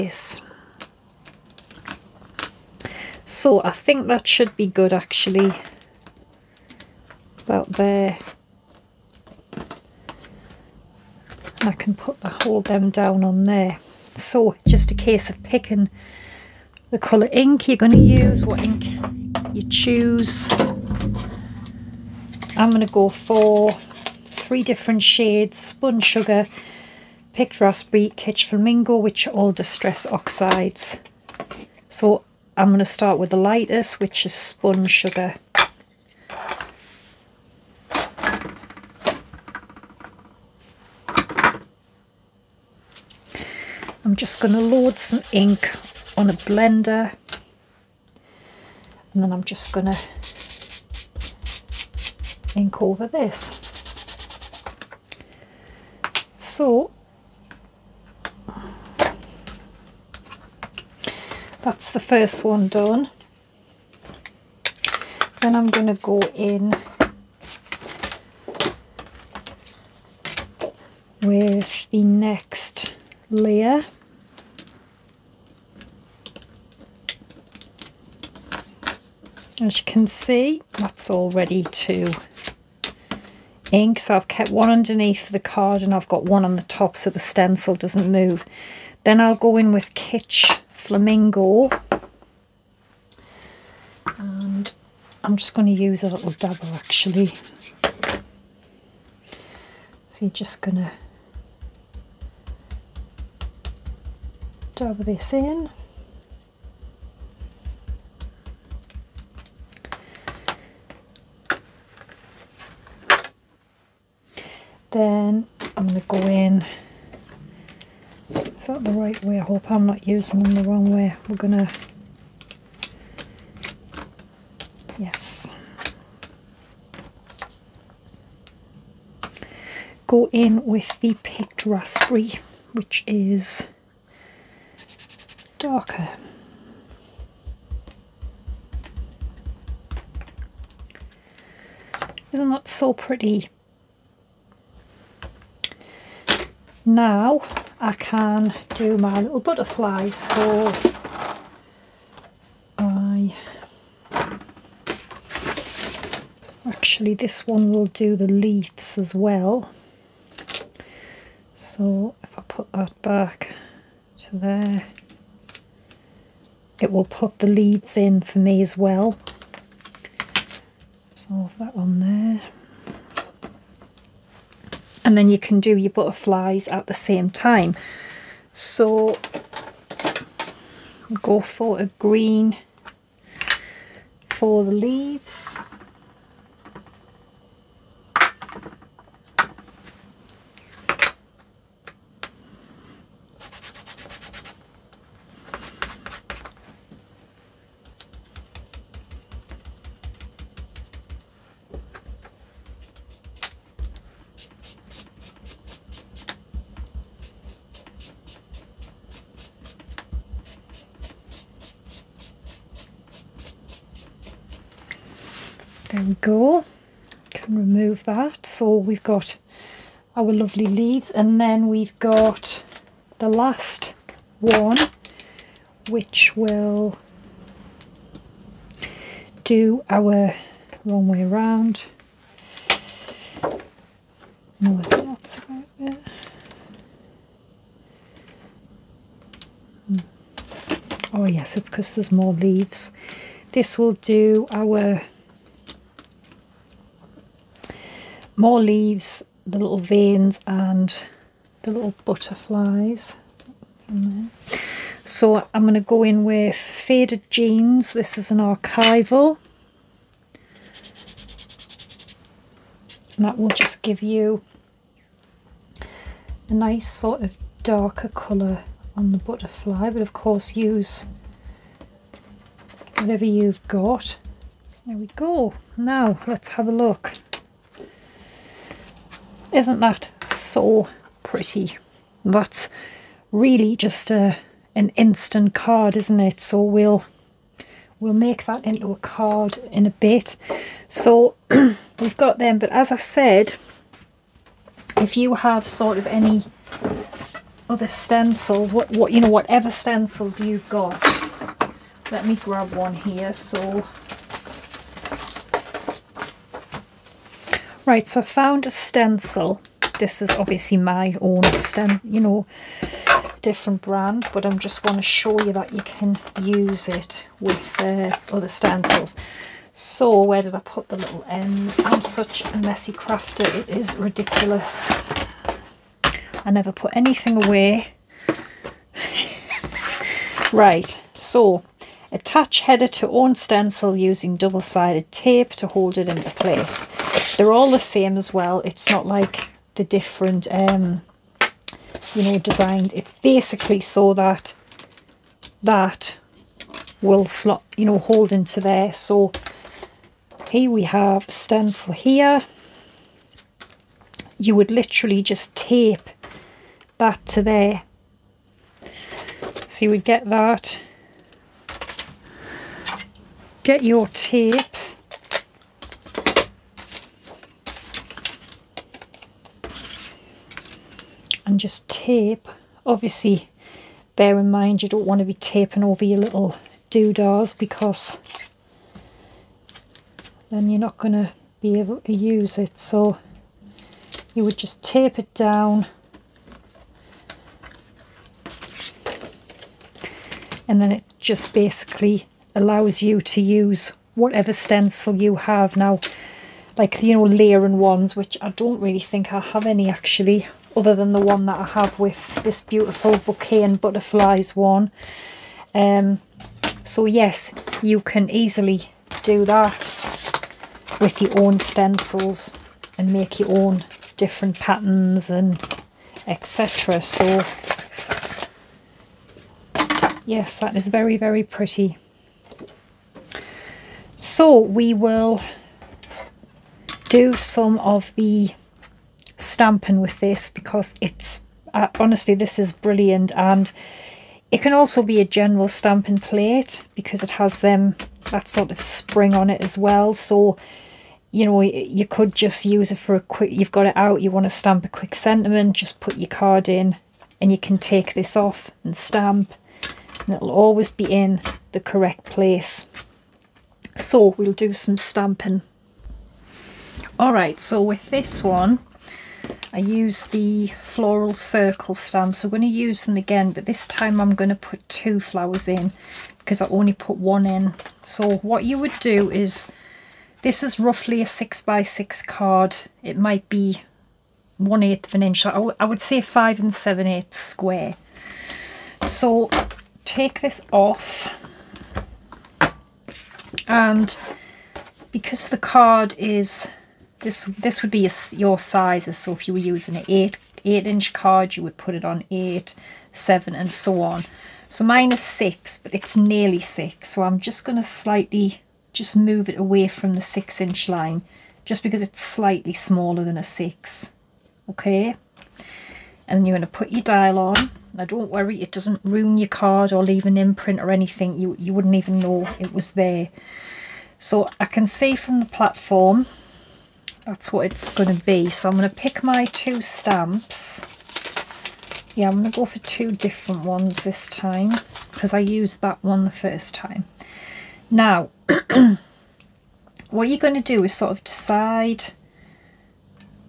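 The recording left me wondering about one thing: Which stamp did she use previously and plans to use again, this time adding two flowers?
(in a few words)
floral circle stamp.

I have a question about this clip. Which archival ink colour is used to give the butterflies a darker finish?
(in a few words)
Faded Jeans.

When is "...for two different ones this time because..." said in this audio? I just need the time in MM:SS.
08:42.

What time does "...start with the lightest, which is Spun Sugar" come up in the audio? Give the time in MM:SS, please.
00:32.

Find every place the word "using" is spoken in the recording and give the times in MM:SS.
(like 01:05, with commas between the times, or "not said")
02:00, 05:33, 08:09.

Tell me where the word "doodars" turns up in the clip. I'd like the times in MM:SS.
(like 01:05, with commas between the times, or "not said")
06:16.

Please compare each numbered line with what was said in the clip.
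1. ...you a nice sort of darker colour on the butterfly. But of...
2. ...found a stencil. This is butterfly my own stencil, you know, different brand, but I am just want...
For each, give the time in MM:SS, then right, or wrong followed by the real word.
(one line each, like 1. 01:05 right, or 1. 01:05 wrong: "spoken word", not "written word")
1. 04:24 right
2. 05:08 wrong: "obviously", not "butterfly".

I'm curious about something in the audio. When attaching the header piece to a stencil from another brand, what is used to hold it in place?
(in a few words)
double-sided tape.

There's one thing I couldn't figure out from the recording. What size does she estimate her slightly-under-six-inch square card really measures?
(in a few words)
5 7/8 inches.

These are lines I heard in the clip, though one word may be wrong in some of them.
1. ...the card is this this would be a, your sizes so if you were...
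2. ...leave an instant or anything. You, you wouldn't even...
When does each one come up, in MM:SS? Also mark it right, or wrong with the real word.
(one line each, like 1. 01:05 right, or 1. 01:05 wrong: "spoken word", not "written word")
1. 08:05 right
2. 08:30 wrong: "imprint", not "instant".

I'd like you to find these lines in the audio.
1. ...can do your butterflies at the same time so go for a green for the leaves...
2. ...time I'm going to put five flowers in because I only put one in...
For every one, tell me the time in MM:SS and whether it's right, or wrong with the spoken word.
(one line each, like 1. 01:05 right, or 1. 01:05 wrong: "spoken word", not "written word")
1. 02:55 right
2. 07:43 wrong: "two", not "five".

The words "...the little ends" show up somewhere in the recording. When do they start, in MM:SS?
05:20.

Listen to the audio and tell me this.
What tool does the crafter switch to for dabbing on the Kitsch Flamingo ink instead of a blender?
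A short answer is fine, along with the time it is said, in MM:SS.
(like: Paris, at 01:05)
dabble, at 01:36.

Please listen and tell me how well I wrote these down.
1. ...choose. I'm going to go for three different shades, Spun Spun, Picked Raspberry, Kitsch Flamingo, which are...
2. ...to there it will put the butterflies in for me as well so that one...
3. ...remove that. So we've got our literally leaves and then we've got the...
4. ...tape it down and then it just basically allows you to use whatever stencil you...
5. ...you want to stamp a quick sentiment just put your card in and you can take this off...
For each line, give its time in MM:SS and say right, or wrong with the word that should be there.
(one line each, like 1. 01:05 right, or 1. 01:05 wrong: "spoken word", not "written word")
1. 00:19 wrong: "Sugar", not "Spun"
2. 02:44 wrong: "leaves", not "butterflies"
3. 03:37 wrong: "lovely", not "literally"
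4. 06:24 right
5. 07:24 right.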